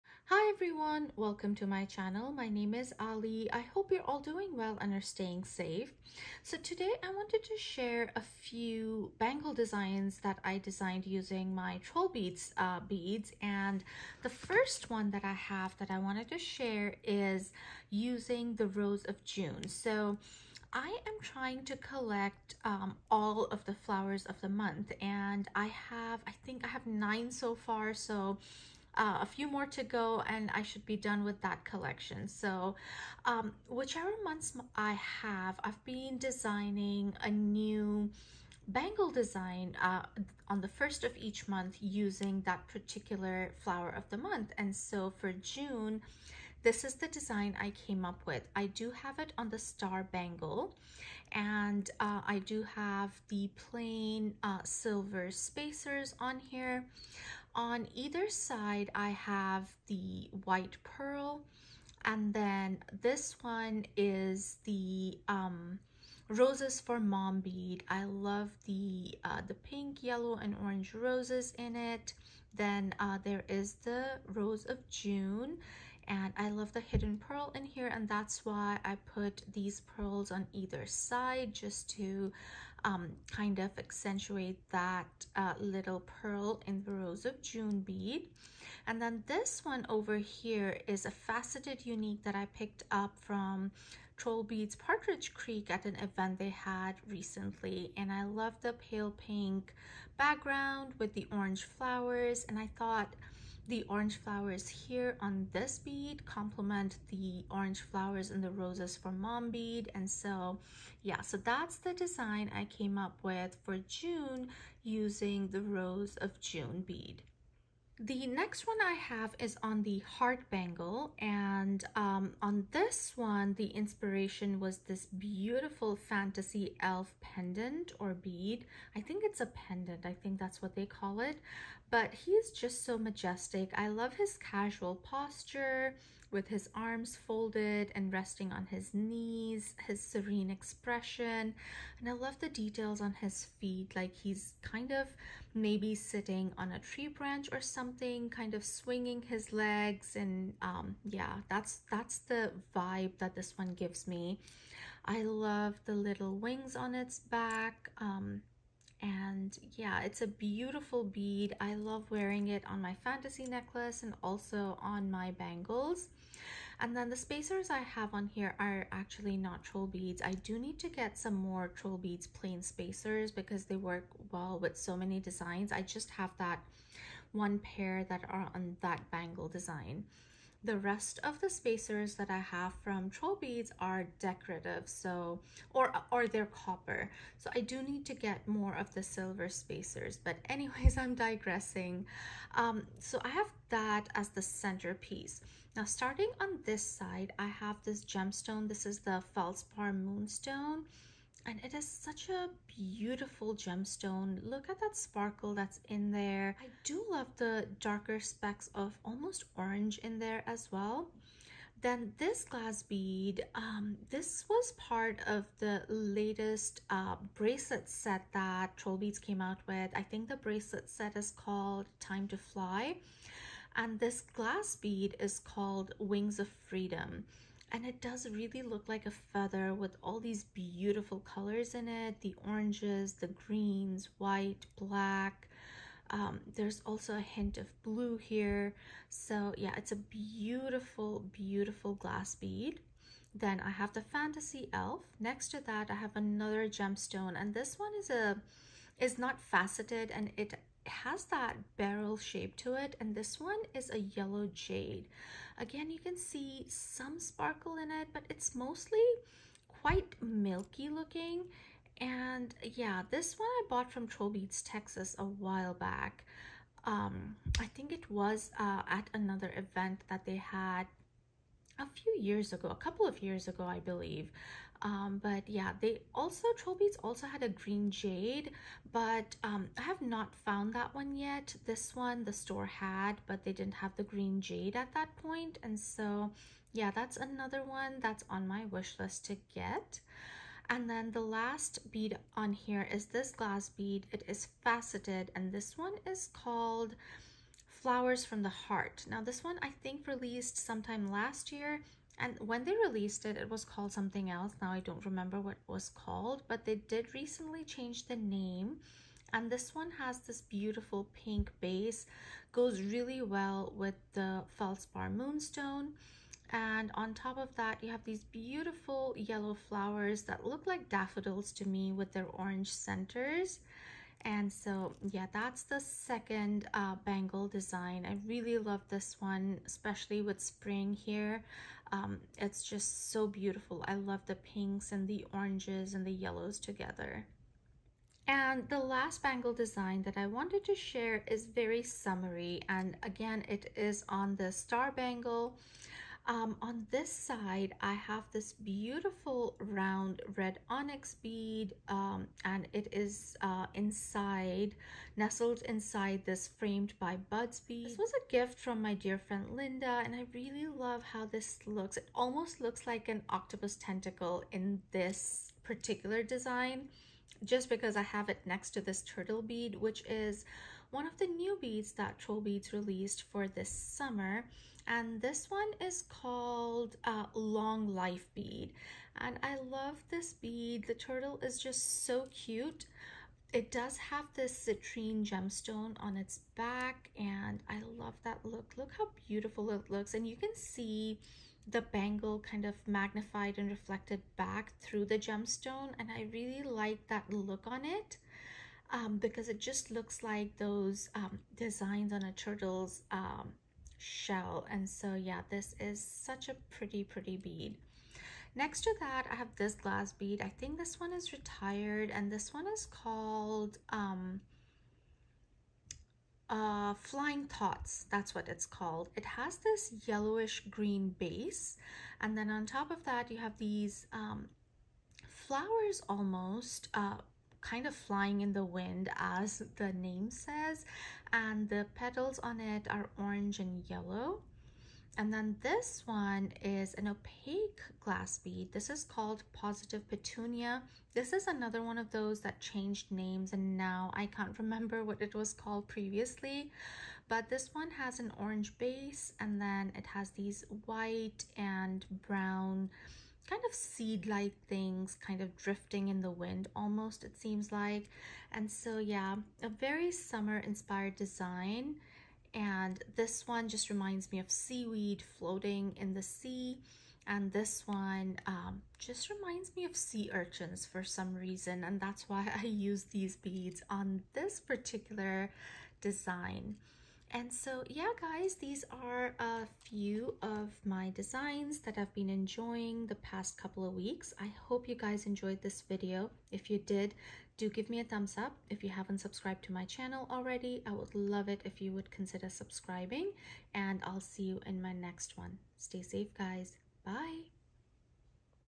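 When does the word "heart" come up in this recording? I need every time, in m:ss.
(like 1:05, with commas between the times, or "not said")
1:59, 4:58.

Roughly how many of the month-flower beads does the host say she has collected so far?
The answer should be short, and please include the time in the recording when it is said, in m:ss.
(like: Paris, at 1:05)
9, at 0:26.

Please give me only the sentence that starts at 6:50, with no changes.
I think this one is retired and this one is called um, uh, Flying Thoughts.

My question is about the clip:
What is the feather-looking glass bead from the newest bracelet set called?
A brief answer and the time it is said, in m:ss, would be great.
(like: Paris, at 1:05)
Wings of Freedom, at 3:45.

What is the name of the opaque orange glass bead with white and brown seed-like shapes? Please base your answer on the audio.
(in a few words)
Positive Petunia.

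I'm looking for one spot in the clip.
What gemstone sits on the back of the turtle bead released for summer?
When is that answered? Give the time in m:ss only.
6:24.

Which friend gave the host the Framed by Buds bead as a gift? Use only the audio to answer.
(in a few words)
Linda.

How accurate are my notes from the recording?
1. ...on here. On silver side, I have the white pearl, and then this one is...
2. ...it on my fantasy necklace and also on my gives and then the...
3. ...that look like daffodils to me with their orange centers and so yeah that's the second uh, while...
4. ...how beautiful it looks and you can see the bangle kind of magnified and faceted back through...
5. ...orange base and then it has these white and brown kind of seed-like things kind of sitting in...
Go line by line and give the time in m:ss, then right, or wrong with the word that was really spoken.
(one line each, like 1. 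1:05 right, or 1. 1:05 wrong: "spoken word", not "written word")
1. 0:56 wrong: "either", not "silver"
2. 2:42 wrong: "bangles", not "gives"
3. 5:20 wrong: "bangle", not "while"
4. 6:28 wrong: "reflected", not "faceted"
5. 7:28 wrong: "drifting", not "sitting".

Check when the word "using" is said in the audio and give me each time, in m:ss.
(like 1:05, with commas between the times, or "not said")
0:11, 0:17, 0:41, 1:54.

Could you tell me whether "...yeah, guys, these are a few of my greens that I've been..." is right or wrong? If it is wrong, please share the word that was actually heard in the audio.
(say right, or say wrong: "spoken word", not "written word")
wrong: "designs", not "greens".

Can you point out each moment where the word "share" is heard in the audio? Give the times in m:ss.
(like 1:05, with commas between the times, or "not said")
0:07, 0:16, 5:40.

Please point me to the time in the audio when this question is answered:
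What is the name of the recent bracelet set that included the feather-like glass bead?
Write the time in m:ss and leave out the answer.
3:41.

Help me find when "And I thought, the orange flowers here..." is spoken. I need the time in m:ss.
1:42.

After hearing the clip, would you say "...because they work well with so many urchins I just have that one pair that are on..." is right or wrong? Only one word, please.
wrong.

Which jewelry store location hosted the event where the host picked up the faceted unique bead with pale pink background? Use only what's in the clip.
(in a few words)
Trollbeads Partridge Creek.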